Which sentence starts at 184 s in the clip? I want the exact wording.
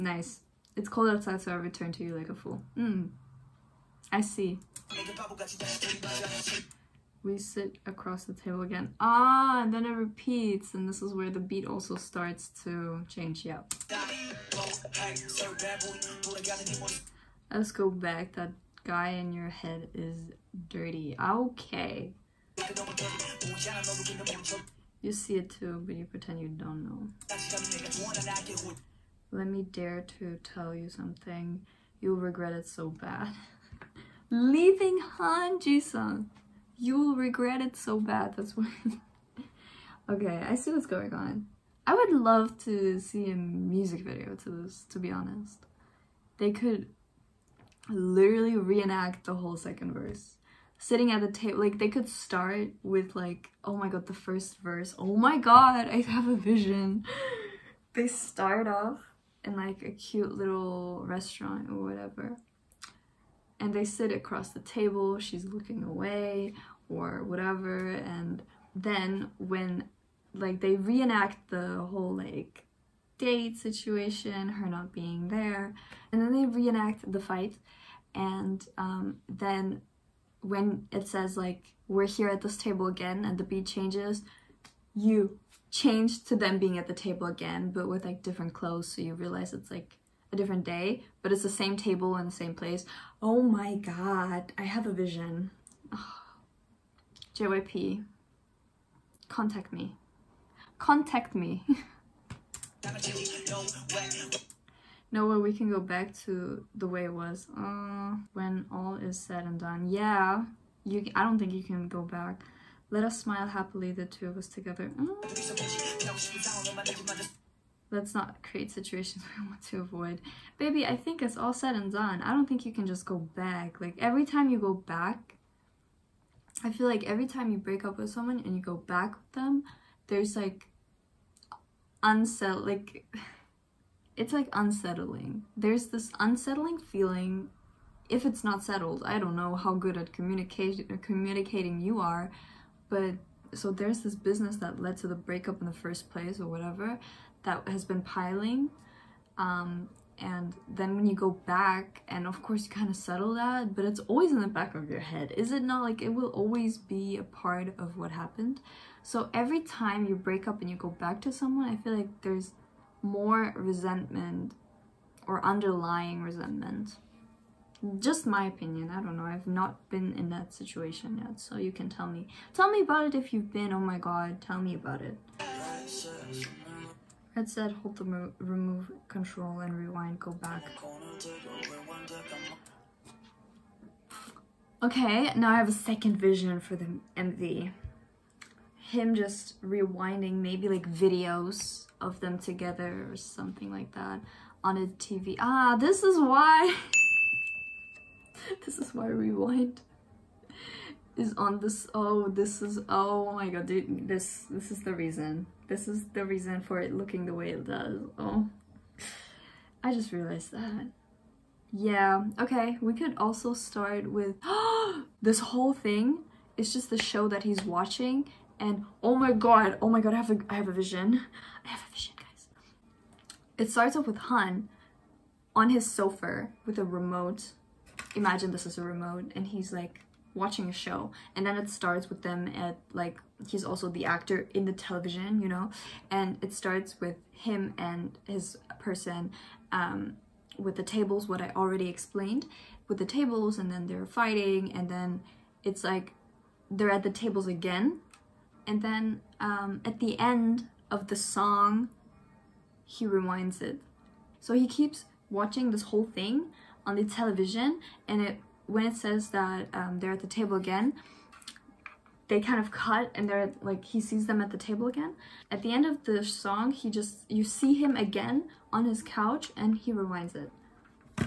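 Okay, now I have a second vision for the MV.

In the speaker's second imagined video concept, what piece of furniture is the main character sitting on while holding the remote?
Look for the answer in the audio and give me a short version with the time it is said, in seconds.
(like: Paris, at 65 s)
sofa, at 225 s.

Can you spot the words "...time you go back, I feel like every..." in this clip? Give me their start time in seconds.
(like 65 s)
124 s.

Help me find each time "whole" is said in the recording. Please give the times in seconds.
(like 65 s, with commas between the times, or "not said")
49 s, 71 s, 215 s, 255 s.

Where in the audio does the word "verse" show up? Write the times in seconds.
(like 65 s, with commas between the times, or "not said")
49 s, 54 s.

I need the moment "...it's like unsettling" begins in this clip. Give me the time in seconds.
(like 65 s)
134 s.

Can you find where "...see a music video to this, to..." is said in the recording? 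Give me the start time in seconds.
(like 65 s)
42 s.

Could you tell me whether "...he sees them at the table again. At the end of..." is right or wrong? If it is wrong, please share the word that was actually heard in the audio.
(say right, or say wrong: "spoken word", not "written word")
right.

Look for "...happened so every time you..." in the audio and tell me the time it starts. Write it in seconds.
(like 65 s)
158 s.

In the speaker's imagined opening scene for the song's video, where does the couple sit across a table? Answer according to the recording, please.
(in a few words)
restaurant.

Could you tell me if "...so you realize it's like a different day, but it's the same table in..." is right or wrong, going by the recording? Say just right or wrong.
right.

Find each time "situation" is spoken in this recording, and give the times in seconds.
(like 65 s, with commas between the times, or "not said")
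73 s, 118 s, 170 s.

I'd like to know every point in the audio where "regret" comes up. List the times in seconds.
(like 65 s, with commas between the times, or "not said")
32 s, 37 s.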